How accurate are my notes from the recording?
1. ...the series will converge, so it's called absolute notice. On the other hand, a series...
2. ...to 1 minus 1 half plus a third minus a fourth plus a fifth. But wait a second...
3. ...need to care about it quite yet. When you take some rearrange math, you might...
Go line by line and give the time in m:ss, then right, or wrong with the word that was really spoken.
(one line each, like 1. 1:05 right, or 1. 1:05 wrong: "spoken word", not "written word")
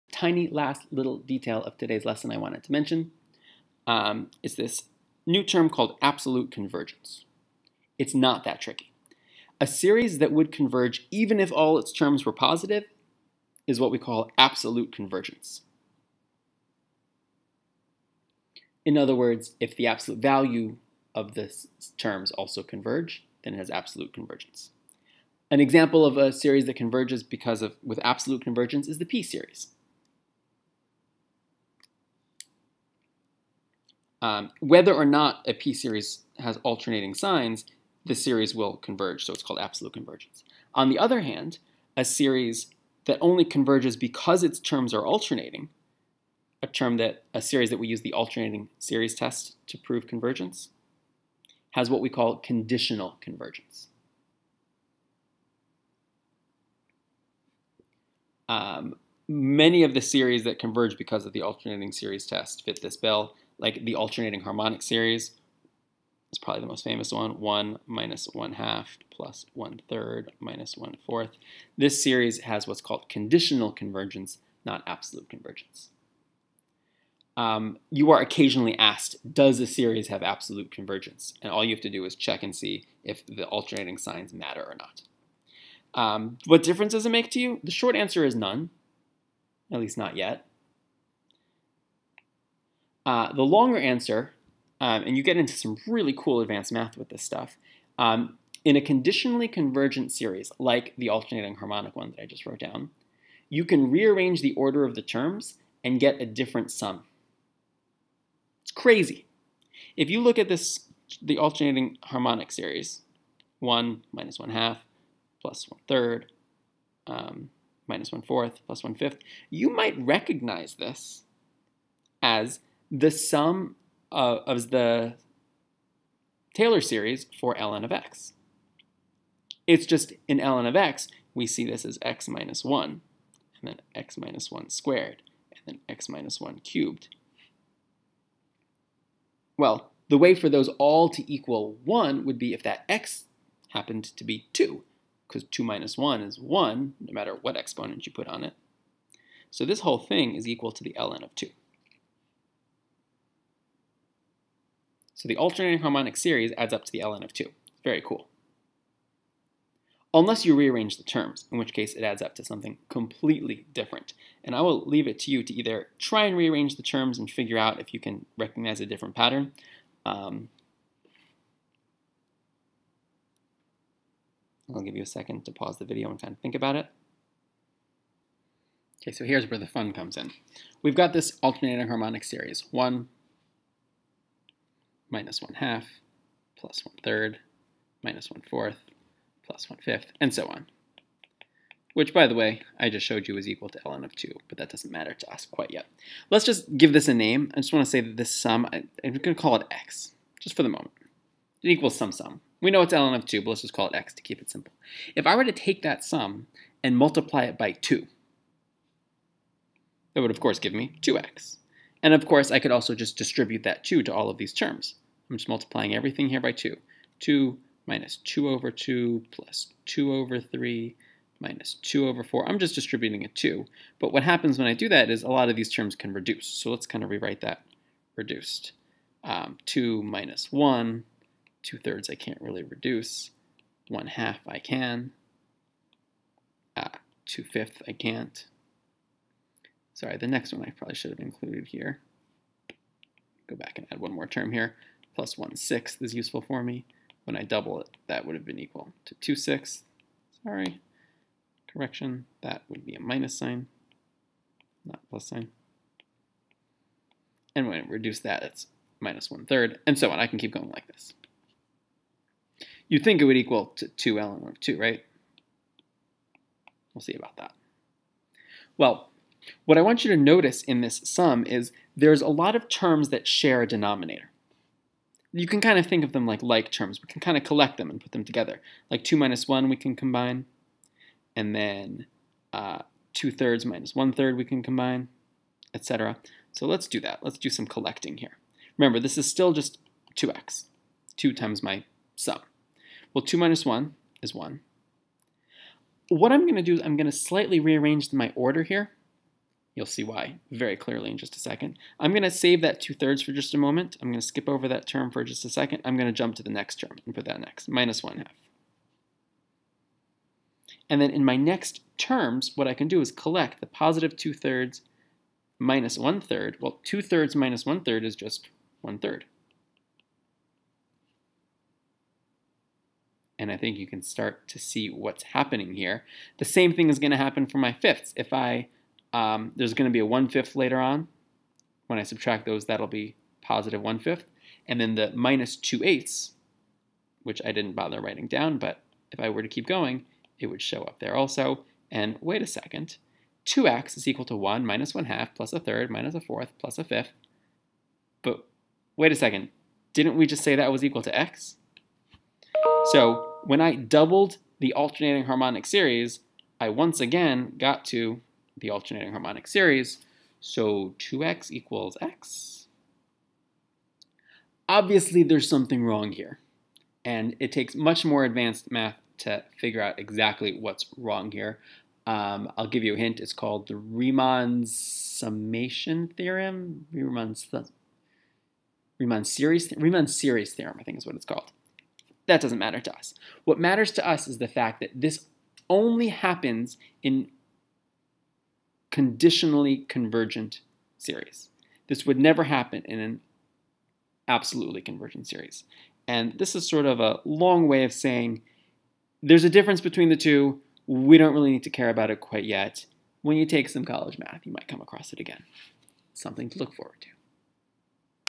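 1. 0:38 wrong: "convergence", not "notice"
2. 5:44 right
3. 6:41 wrong: "college", not "rearrange".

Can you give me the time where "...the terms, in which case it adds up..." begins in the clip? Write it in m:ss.
2:40.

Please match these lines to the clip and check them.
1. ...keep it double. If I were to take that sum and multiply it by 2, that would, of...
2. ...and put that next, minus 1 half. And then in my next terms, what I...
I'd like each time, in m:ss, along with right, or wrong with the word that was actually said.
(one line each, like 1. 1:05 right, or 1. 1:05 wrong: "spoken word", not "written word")
1. 3:24 wrong: "simple", not "double"
2. 5:07 right.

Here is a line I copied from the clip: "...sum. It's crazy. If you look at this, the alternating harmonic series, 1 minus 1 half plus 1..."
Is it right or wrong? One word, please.
right.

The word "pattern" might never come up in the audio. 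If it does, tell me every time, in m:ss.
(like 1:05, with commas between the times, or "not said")
2:49.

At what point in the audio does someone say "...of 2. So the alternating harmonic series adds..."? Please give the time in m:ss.
2:31.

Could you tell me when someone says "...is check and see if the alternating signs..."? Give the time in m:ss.
1:22.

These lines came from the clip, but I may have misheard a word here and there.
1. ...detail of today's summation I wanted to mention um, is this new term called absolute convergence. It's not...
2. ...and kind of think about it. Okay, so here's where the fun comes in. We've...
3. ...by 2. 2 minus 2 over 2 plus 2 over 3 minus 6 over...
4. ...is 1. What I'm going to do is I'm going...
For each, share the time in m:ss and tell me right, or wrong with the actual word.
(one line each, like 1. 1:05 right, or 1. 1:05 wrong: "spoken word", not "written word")
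1. 0:01 wrong: "lesson", not "summation"
2. 2:56 right
3. 3:36 wrong: "2", not "6"
4. 4:54 right.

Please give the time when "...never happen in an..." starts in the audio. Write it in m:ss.
6:32.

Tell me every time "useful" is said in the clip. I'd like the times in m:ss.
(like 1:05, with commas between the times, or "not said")
4:06.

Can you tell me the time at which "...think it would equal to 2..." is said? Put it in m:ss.
4:22.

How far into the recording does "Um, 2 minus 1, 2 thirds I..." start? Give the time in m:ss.
3:49.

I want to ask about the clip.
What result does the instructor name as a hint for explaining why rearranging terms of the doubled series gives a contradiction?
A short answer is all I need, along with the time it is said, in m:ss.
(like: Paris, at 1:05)
Riemann series theorem, at 6:19.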